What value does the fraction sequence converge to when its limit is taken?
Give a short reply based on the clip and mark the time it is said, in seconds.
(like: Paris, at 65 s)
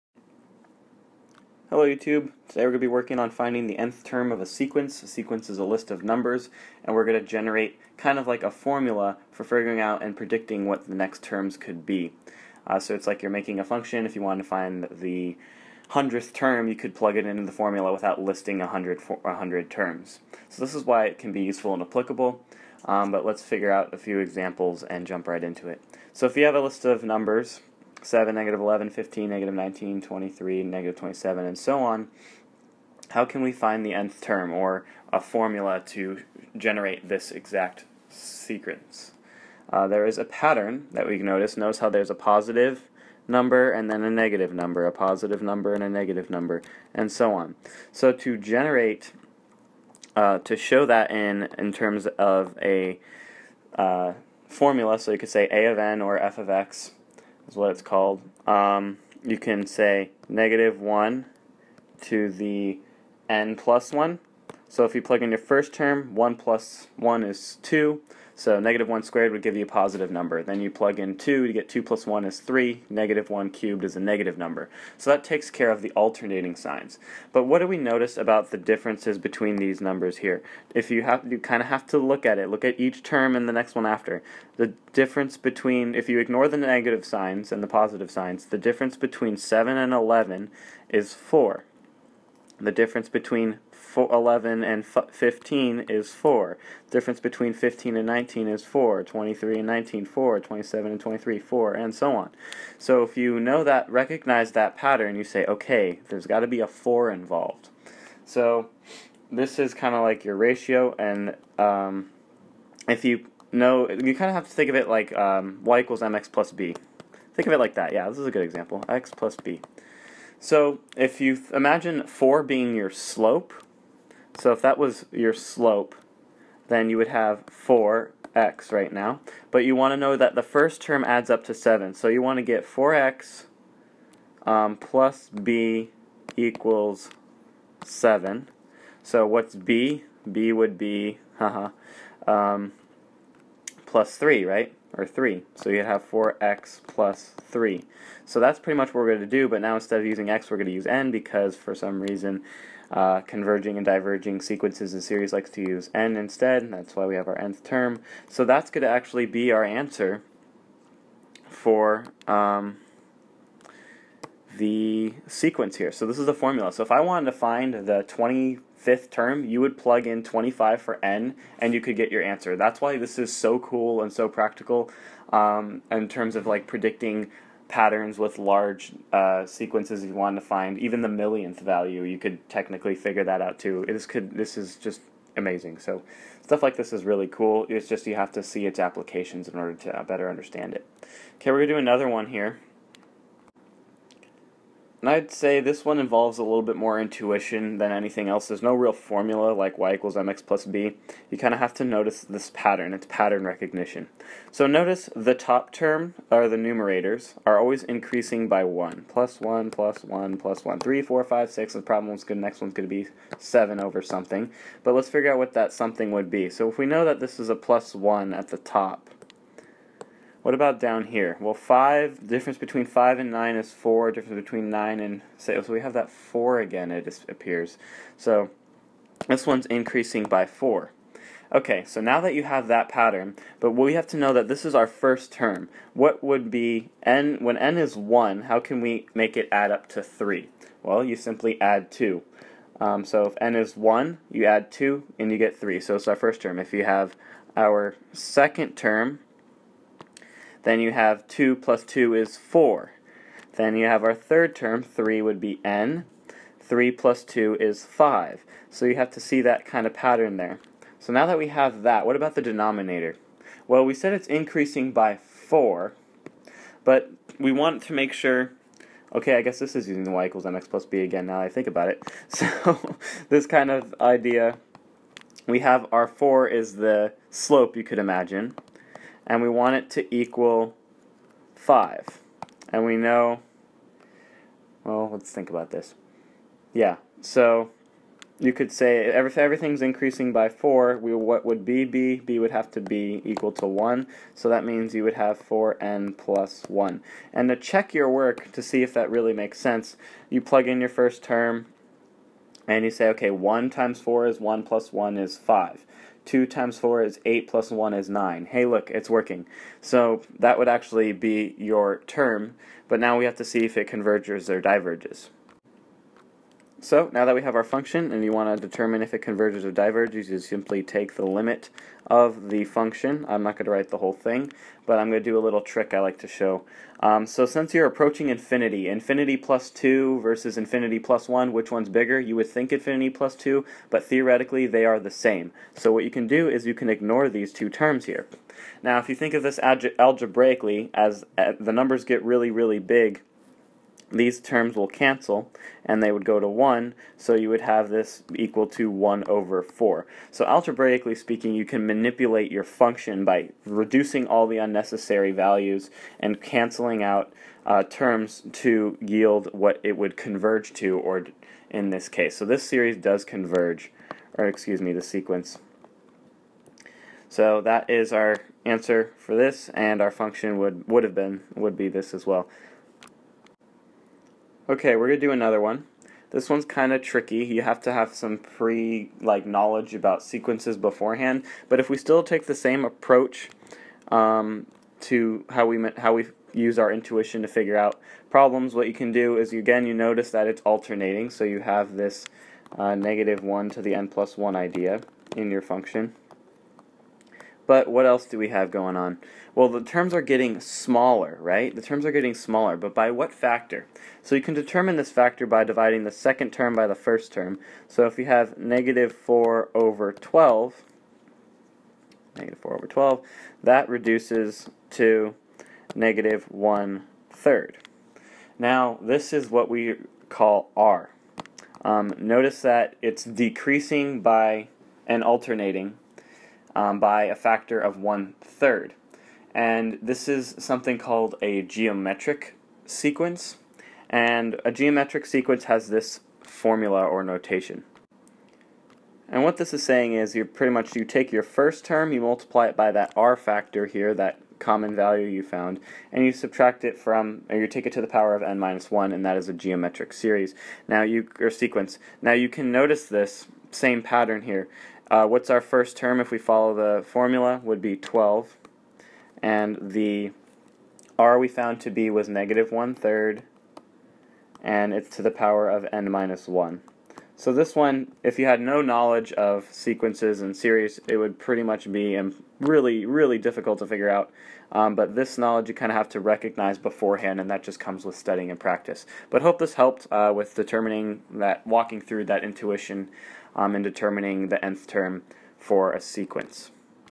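1/4, at 348 s.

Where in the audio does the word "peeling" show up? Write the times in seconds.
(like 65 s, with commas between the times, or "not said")
not said.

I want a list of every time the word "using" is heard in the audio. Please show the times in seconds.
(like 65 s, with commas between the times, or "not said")
150 s, 269 s.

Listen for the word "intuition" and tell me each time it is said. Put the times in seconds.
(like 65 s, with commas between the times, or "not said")
196 s, 386 s, 482 s.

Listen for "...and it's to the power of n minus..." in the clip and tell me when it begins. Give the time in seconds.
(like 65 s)
464 s.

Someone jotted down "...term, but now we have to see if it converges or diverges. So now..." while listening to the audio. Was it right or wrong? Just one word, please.
right.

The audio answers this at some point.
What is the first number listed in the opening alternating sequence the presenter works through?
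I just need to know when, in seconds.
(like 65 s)
28 s.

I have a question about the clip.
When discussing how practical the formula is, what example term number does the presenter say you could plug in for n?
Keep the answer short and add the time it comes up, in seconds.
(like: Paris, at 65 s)
25th, at 168 s.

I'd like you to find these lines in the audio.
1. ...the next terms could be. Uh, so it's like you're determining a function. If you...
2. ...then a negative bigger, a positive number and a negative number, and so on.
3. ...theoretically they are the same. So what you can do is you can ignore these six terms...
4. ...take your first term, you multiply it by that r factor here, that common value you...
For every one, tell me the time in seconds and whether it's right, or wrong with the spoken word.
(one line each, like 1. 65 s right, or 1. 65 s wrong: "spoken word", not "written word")
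1. 10 s wrong: "making", not "determining"
2. 43 s wrong: "number", not "bigger"
3. 334 s wrong: "two", not "six"
4. 441 s right.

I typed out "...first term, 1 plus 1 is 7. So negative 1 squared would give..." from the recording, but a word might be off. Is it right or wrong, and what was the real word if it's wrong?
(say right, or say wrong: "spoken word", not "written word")
wrong: "2", not "7".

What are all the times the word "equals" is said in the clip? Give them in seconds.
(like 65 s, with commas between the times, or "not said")
115 s, 136 s, 199 s, 270 s, 280 s, 293 s, 348 s.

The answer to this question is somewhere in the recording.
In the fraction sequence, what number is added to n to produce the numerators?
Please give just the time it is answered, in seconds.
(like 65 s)
241 s.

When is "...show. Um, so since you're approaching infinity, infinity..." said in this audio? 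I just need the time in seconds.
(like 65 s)
326 s.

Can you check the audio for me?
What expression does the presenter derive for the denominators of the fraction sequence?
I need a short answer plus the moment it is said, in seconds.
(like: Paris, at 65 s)
4n plus 1, at 295 s.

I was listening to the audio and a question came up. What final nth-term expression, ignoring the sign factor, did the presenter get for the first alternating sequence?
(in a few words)
4n plus 3.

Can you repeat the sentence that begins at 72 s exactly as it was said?
Negative 1 cubed is a negative number.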